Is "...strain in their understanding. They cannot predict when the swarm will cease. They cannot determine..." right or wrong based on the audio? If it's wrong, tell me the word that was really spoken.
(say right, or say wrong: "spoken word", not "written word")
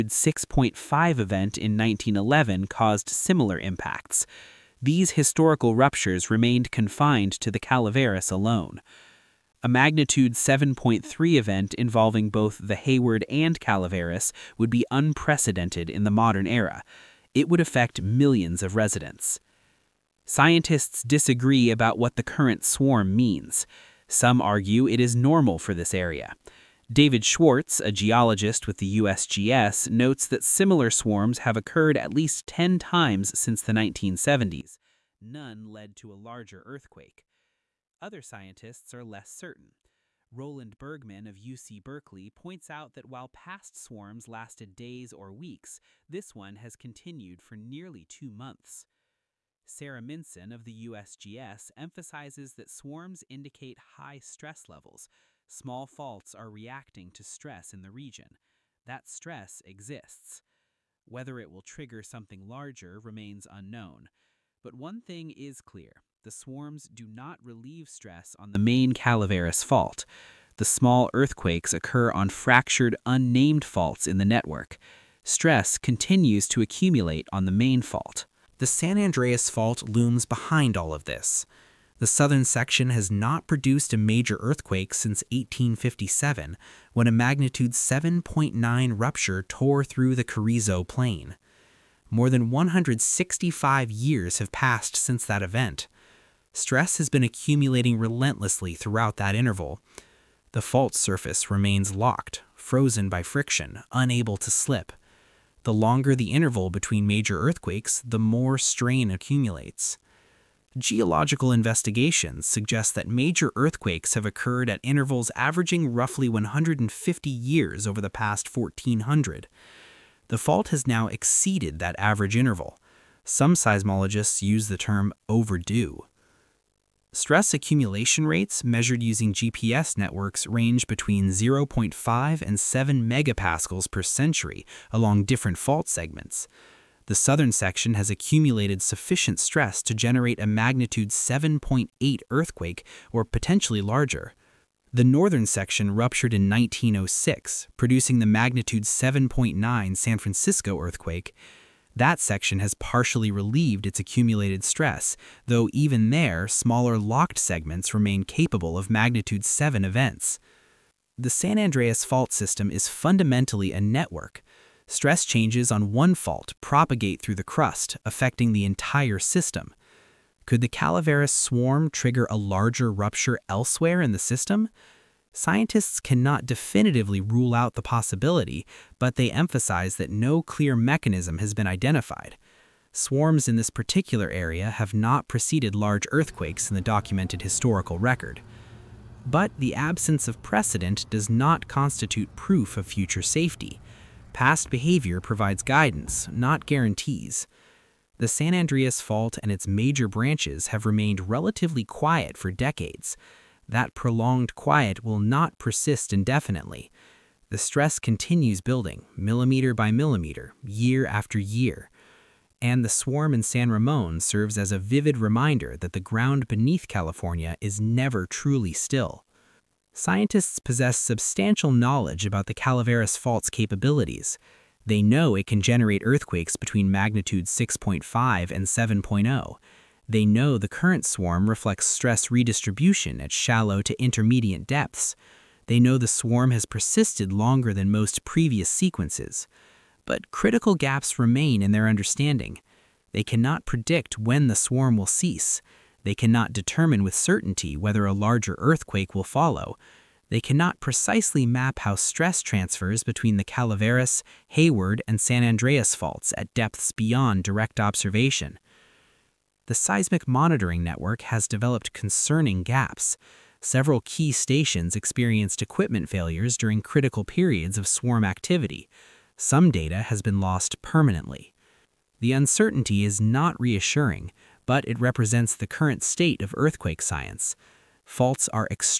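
wrong: "remain", not "strain".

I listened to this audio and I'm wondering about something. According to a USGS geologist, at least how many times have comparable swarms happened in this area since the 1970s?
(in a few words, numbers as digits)
10.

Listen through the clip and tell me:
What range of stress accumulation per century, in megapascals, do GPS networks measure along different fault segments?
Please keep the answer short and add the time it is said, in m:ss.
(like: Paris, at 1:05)
0.5 to 7 megapascals, at 2:11.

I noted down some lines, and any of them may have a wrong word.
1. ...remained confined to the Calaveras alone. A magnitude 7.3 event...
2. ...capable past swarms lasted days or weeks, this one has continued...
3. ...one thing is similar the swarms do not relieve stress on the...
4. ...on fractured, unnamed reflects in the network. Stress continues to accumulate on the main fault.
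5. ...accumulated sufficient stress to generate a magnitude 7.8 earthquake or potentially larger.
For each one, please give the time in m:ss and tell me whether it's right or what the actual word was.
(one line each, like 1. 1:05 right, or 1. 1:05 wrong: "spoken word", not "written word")
1. 0:06 right
2. 0:43 wrong: "while", not "capable"
3. 1:04 wrong: "clear", not "similar"
4. 1:12 wrong: "faults", not "reflects"
5. 2:18 right.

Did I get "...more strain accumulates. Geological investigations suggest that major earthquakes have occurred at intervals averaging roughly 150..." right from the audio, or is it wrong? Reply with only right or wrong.
right.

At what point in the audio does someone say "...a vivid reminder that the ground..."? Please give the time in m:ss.
3:34.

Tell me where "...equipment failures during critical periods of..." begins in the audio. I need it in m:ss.
4:25.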